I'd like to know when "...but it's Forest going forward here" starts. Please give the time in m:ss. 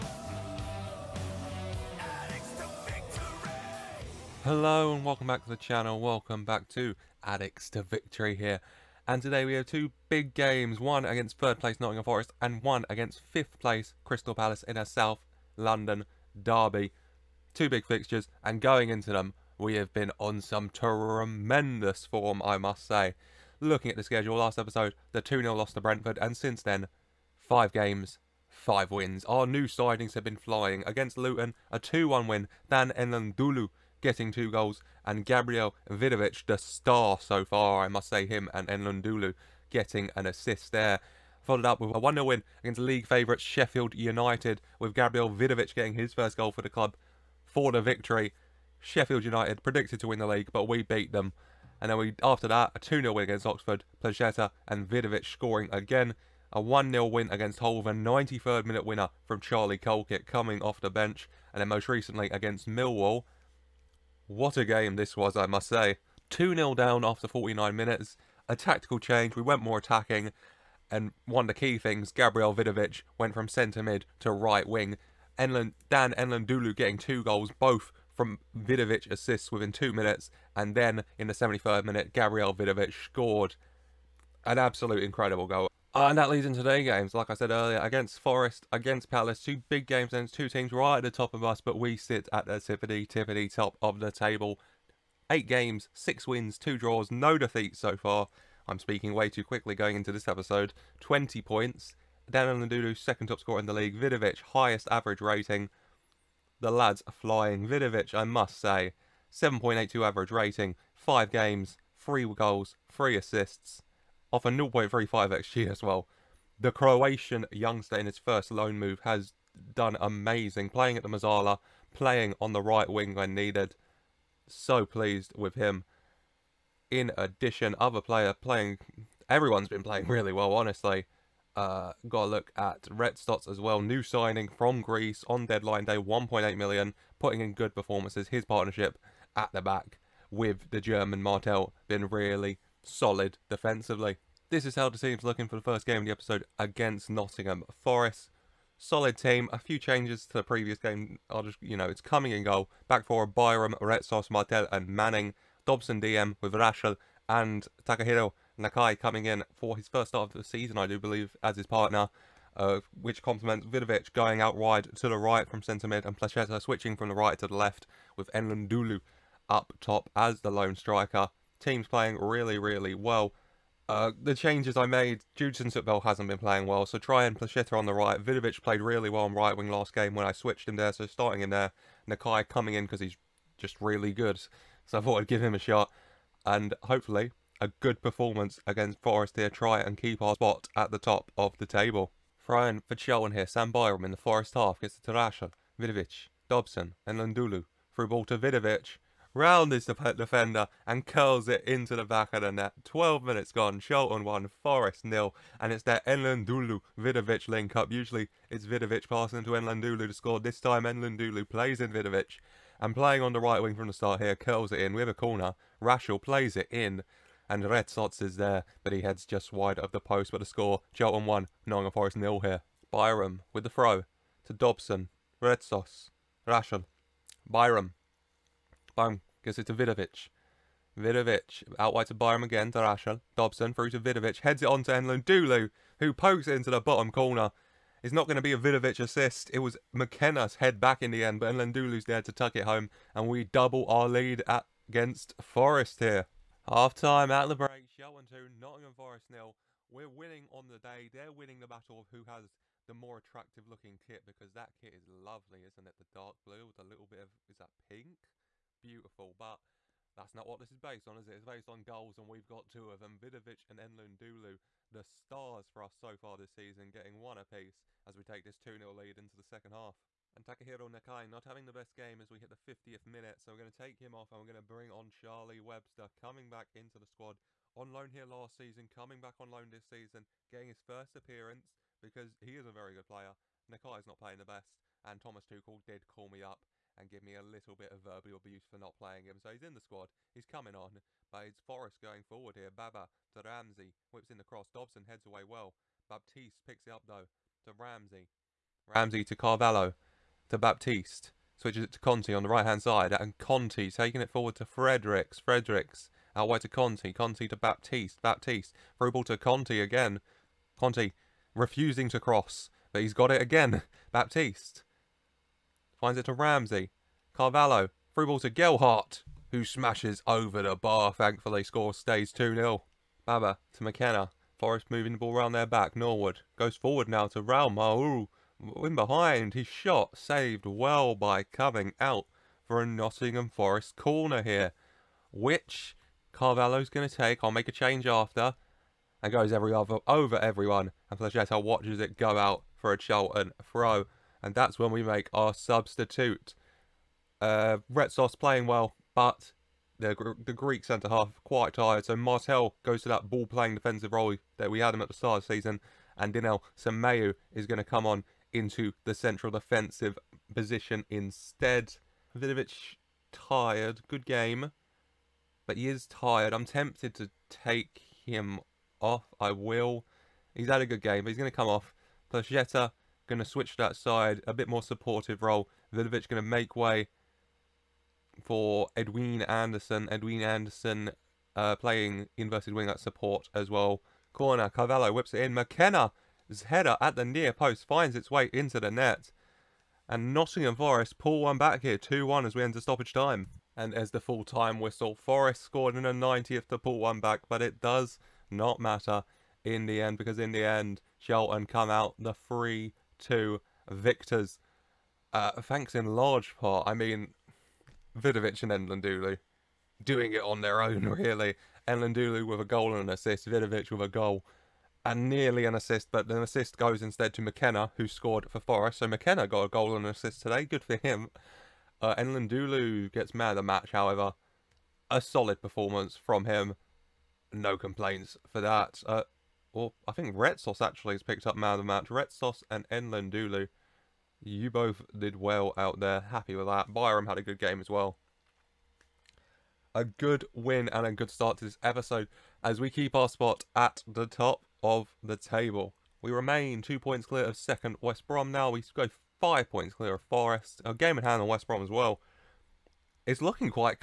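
4:51.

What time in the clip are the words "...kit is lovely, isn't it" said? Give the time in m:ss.
4:14.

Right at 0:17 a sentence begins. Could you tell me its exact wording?
Two big fixtures and going into them we have been on some tremendous form I must say.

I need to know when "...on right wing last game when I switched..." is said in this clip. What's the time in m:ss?
2:59.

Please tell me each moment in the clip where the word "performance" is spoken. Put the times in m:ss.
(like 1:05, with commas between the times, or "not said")
2:17, 3:08, 7:05.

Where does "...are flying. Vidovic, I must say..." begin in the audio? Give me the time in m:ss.
1:47.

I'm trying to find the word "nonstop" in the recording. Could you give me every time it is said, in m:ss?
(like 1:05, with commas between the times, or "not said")
not said.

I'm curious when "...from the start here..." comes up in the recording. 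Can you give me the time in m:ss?
3:33.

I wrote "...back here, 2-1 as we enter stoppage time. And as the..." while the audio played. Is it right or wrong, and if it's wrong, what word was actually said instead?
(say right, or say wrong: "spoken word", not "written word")
right.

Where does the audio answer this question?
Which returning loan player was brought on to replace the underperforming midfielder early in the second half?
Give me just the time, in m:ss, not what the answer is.
4:35.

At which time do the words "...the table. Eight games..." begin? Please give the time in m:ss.
1:34.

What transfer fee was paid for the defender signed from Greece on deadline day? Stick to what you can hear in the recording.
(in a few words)
1.8 million.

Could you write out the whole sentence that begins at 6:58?
So McKenna got a goal and an assist today.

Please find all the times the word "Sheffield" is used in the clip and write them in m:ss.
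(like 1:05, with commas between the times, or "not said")
0:43, 0:48.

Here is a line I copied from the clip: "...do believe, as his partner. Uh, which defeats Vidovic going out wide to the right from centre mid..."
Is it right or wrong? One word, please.
wrong.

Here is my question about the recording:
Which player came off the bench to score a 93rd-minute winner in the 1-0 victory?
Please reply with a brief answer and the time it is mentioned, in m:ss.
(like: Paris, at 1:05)
Charlie Colkett, at 0:59.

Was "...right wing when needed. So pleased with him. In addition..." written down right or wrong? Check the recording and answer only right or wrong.
right.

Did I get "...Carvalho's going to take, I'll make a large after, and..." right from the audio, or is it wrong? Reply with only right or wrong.
wrong.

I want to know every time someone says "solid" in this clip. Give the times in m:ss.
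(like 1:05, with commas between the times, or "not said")
2:22, 2:28, 7:05.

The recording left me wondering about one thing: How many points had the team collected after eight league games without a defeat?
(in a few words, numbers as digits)
20.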